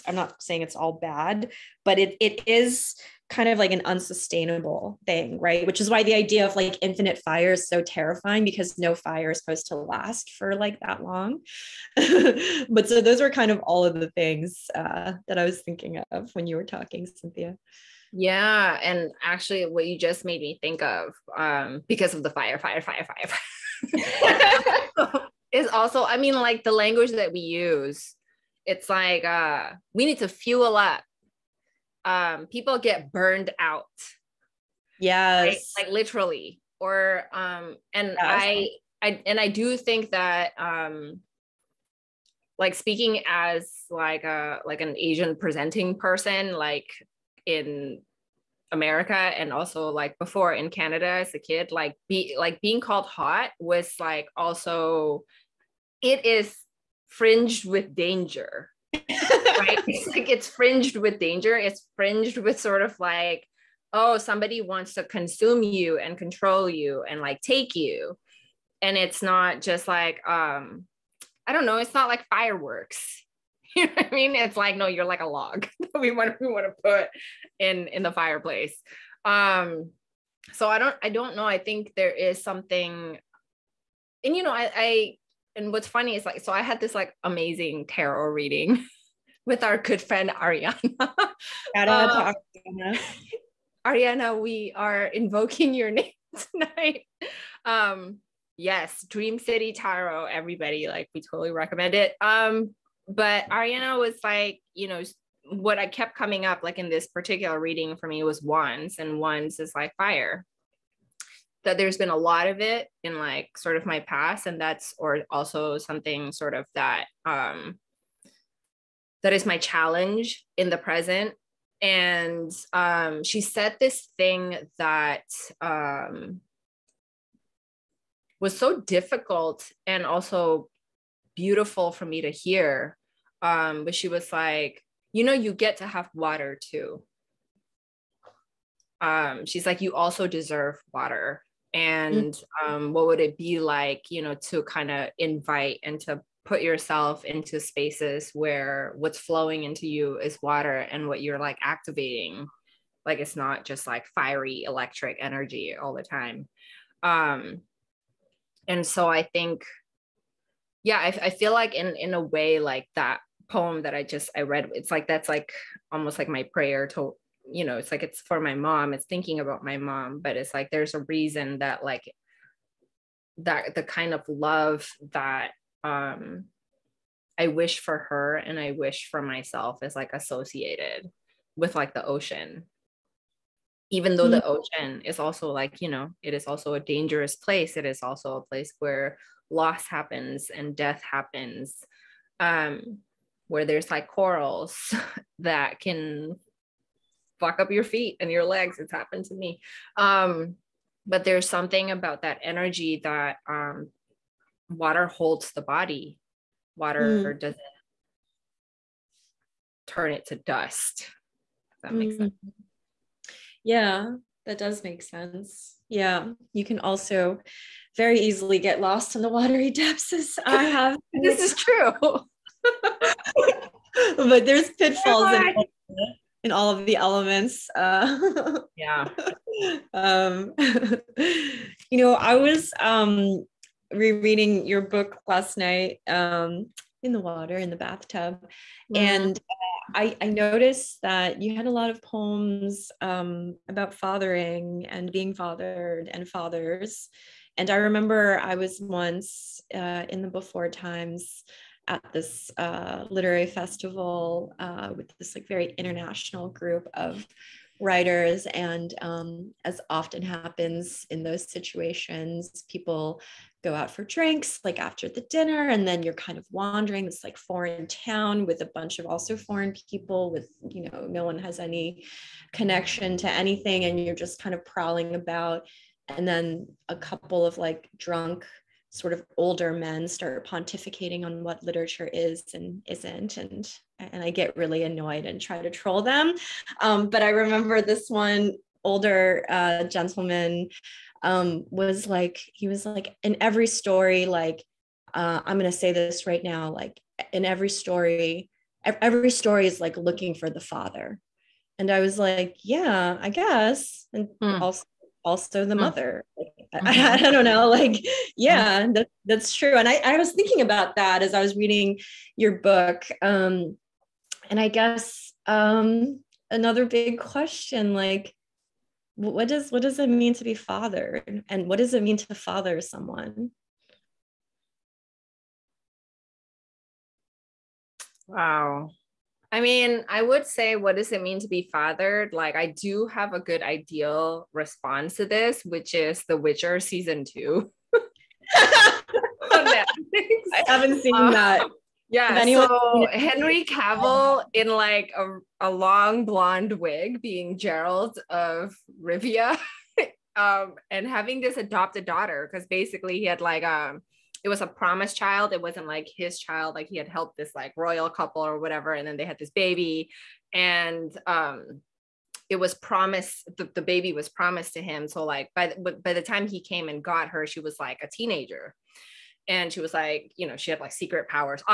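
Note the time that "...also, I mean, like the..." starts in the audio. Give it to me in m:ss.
0:25.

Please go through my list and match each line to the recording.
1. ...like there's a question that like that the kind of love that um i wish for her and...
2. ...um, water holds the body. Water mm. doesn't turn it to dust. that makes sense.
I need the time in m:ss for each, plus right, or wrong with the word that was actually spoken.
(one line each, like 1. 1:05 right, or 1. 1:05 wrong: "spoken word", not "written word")
1. 2:50 wrong: "reason", not "question"
2. 3:23 right.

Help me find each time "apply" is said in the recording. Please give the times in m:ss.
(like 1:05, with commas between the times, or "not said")
not said.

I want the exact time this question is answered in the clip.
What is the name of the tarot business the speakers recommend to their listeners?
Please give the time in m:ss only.
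1:39.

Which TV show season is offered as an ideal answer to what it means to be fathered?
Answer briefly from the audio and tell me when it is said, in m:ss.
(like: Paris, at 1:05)
The Witcher season 2, at 5:36.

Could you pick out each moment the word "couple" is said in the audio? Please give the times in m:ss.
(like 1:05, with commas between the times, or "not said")
4:36, 5:58.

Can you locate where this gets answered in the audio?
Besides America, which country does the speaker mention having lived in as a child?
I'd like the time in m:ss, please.
0:50.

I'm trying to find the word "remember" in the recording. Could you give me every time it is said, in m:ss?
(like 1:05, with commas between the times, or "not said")
4:07, 4:47.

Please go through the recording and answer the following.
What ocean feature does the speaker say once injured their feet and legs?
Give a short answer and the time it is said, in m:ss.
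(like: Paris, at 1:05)
Corals, at 3:14.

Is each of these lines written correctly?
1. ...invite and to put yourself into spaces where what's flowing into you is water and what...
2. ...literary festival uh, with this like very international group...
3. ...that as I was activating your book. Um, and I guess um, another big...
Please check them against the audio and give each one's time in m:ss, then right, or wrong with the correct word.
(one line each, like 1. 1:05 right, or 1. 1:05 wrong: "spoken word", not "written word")
1. 2:25 right
2. 4:13 right
3. 5:10 wrong: "reading", not "activating".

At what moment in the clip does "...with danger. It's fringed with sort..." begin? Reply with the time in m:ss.
1:00.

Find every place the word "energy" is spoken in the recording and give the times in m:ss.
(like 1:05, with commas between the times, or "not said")
2:35, 3:22.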